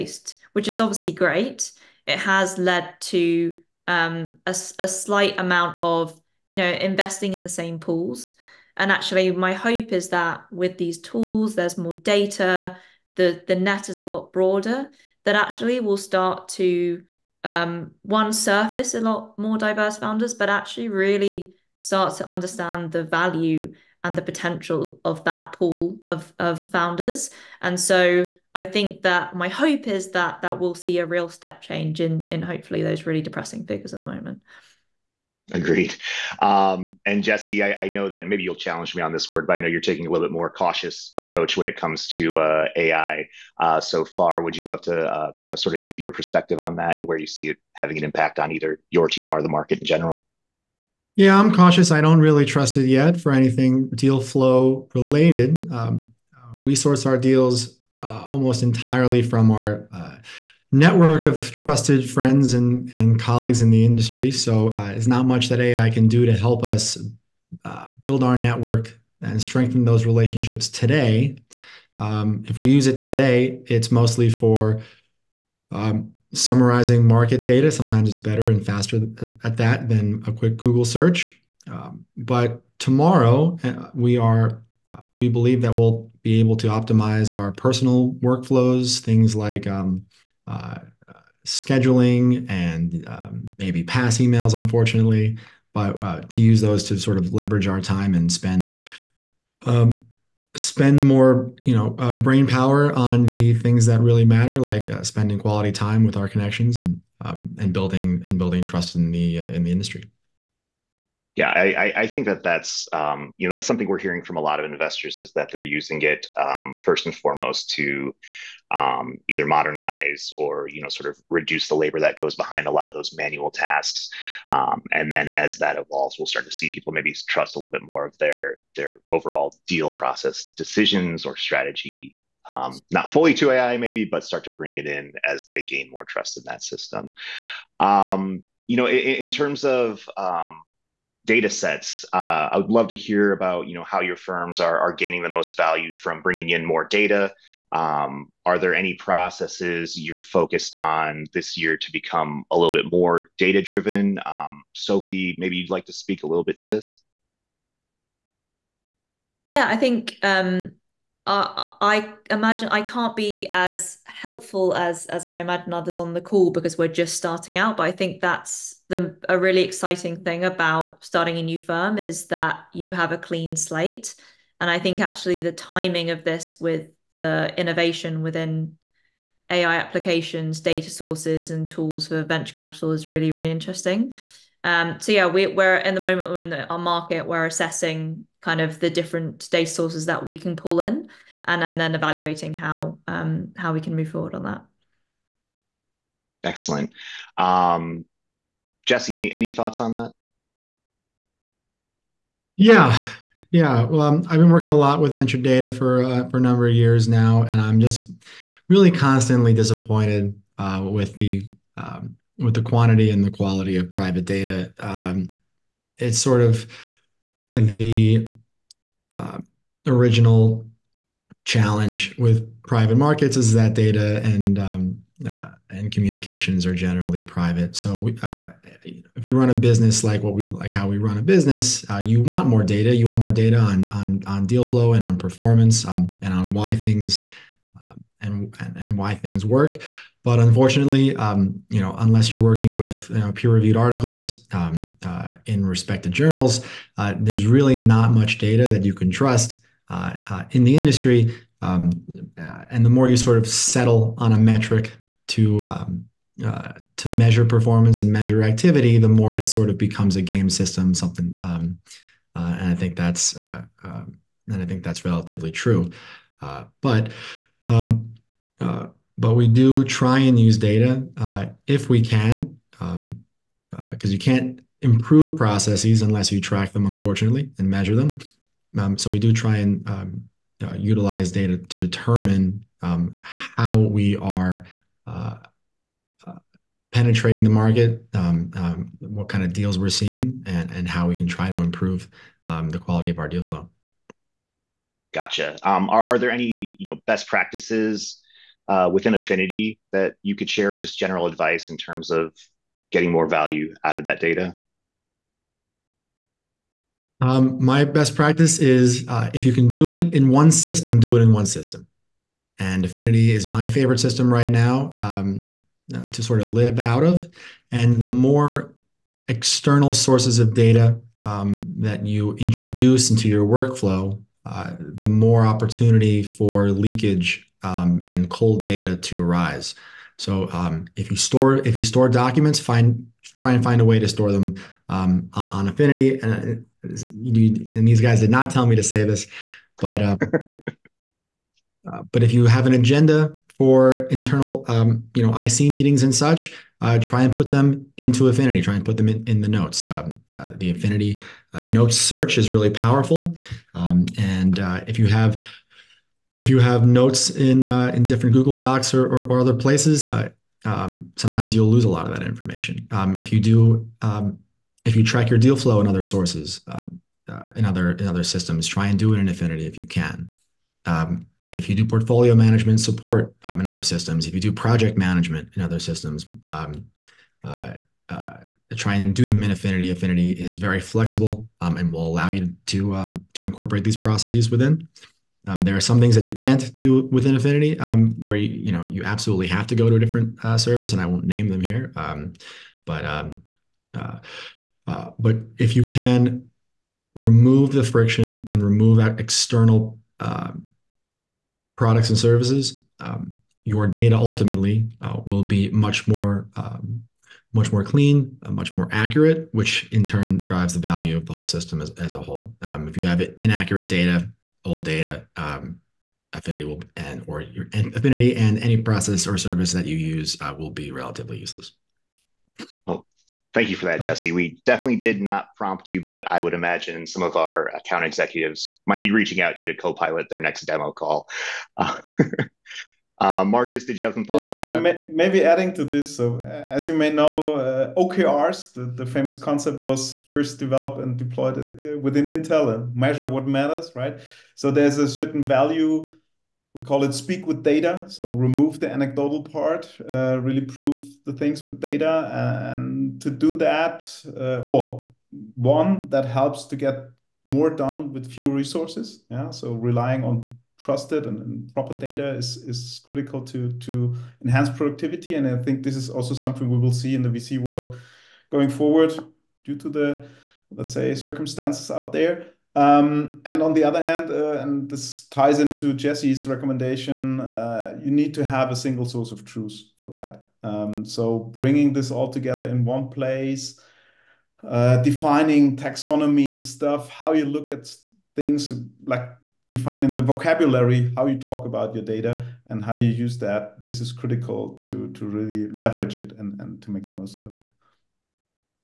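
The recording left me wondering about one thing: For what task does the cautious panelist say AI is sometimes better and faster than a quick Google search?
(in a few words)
summarizing market data.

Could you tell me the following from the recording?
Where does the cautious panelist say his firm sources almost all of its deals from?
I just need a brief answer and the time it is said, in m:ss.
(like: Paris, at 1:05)
network of trusted friends, at 1:00.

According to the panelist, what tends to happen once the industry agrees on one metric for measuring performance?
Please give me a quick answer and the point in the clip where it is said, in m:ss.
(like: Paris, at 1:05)
becomes a game system, at 4:19.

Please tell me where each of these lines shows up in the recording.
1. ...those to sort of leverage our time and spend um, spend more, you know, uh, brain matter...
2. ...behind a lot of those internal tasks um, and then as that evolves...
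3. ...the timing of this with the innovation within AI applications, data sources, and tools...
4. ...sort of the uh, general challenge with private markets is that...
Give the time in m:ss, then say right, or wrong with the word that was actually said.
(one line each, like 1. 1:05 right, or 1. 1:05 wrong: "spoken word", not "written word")
1. 1:36 wrong: "power", not "matter"
2. 2:02 wrong: "manual", not "internal"
3. 2:55 right
4. 3:36 wrong: "original", not "general".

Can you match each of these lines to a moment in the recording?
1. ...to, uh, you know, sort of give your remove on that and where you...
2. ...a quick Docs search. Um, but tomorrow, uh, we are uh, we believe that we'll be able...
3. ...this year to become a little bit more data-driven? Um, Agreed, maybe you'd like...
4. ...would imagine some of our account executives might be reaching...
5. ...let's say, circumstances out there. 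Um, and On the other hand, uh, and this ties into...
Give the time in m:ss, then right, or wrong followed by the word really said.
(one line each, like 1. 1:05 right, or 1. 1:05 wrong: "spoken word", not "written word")
1. 0:44 wrong: "perspective", not "remove"
2. 1:20 wrong: "Google", not "Docs"
3. 2:31 wrong: "Sophie", not "Agreed"
4. 7:06 right
5. 7:50 right.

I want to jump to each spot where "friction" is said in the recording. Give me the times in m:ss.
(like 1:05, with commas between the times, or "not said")
6:37.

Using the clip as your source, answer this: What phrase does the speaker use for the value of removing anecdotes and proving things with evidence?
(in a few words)
speak with data.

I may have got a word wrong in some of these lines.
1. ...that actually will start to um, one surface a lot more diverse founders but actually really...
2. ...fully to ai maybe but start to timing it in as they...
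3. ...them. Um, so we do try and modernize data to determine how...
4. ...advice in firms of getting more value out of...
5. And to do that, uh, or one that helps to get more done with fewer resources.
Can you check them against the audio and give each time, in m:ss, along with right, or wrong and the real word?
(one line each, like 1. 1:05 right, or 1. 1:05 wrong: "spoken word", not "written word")
1. 0:15 right
2. 2:13 wrong: "bring", not "timing"
3. 4:37 wrong: "utilize", not "modernize"
4. 5:01 wrong: "terms", not "firms"
5. 7:32 right.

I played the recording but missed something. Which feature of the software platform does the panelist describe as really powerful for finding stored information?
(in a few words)
notes search.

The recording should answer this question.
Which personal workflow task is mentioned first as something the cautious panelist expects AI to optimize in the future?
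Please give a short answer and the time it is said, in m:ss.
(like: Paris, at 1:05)
scheduling, at 1:31.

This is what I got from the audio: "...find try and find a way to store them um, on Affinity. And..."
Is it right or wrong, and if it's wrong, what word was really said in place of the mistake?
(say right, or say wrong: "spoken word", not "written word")
right.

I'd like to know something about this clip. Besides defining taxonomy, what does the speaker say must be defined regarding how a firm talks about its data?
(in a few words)
vocabulary.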